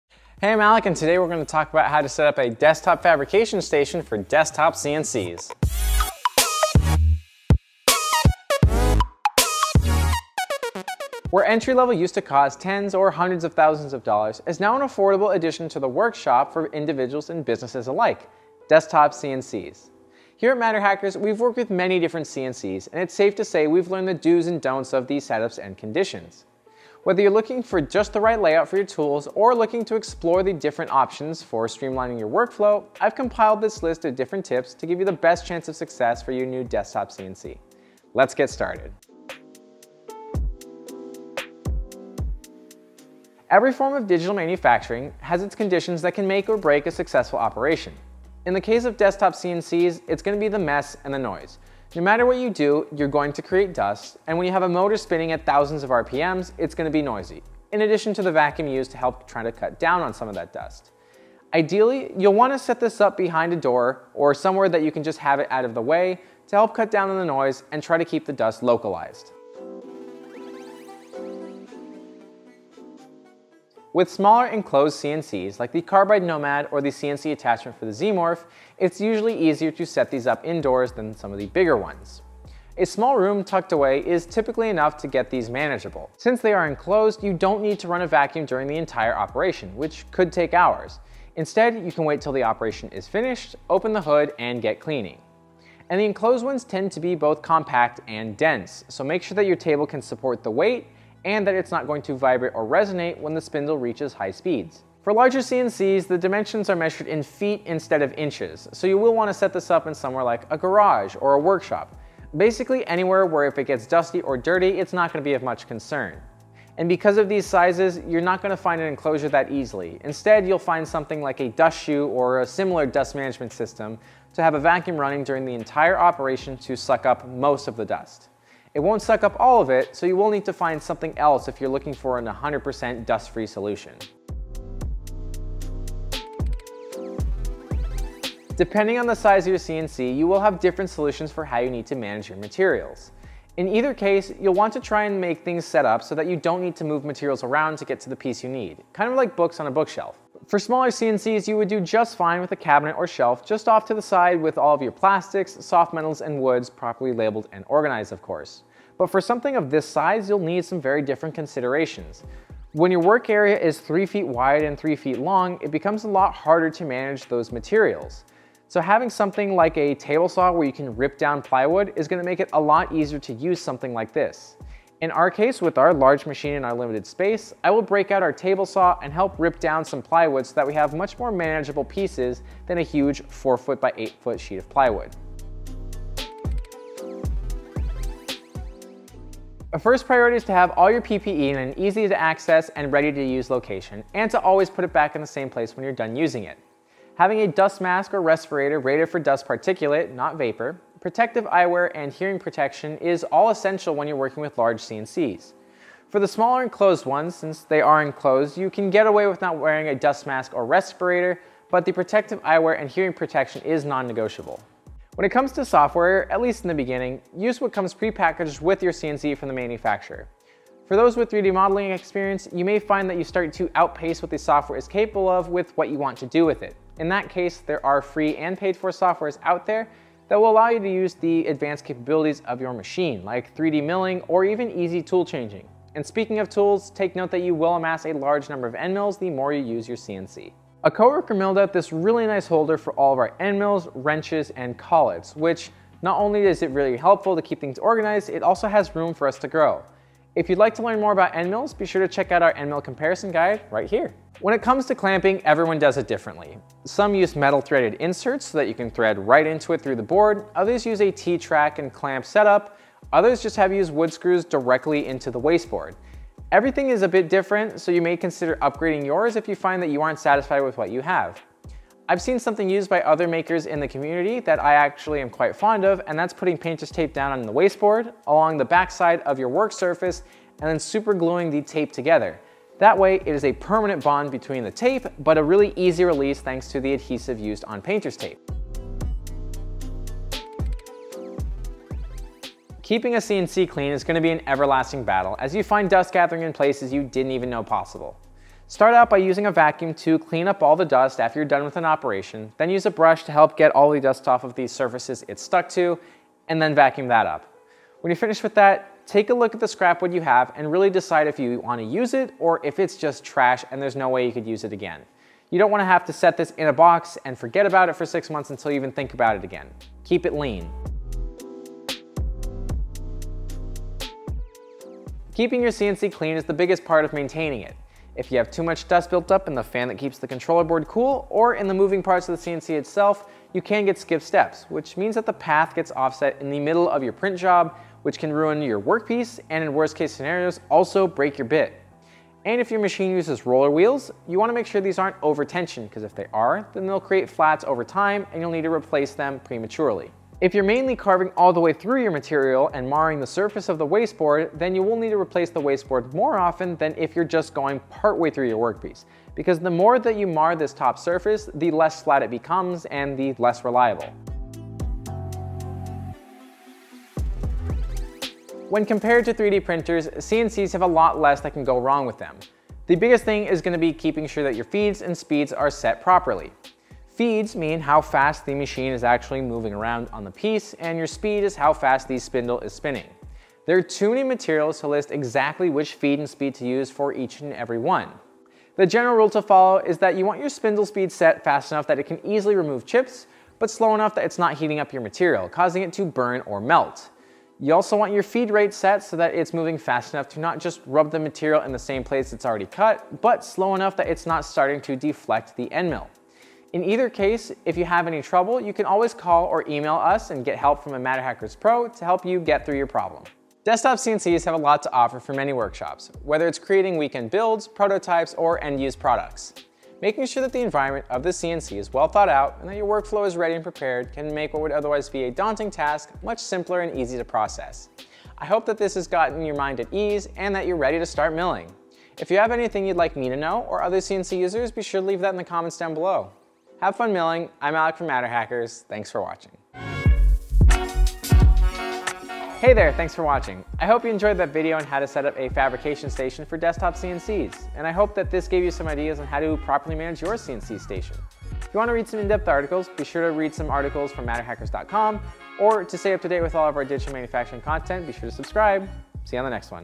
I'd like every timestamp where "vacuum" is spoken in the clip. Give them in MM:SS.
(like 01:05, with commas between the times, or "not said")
00:58, 01:28, 02:04, 04:59, 05:06.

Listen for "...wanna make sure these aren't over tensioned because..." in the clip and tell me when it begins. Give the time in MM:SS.
05:44.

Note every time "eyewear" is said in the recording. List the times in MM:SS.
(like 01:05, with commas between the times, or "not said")
03:21, 03:32.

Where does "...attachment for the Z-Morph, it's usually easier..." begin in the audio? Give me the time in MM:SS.
01:17.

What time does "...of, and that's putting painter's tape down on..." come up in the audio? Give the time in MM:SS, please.
04:35.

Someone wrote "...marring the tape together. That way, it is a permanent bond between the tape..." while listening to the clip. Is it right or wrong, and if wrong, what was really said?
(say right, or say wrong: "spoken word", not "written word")
wrong: "gluing", not "marring".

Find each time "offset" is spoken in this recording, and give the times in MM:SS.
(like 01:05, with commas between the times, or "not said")
05:35.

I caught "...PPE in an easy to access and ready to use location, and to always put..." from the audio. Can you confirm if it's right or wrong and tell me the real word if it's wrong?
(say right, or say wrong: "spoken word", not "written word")
right.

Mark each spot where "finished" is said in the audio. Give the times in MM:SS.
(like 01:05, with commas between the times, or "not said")
01:33, 05:08.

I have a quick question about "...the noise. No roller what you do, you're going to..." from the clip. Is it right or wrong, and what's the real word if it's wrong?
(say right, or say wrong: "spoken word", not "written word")
wrong: "matter", not "roller".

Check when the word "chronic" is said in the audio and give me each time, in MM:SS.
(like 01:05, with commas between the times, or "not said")
not said.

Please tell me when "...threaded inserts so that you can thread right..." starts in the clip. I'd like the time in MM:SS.
04:17.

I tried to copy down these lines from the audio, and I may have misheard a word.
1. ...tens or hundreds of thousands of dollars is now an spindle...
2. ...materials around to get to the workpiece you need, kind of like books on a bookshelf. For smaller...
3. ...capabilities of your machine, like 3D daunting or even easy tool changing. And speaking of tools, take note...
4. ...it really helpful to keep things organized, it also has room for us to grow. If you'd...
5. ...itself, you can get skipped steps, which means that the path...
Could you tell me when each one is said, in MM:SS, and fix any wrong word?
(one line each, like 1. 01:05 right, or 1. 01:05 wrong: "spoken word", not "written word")
1. 00:12 wrong: "affordable", not "spindle"
2. 02:27 wrong: "piece", not "workpiece"
3. 03:51 wrong: "milling", not "daunting"
4. 04:06 right
5. 05:32 right.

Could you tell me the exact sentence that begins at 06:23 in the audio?
There are too many materials to list exactly which feed and speed to use for each and every one.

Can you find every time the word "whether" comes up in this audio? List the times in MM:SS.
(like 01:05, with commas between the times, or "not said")
00:27, 06:56.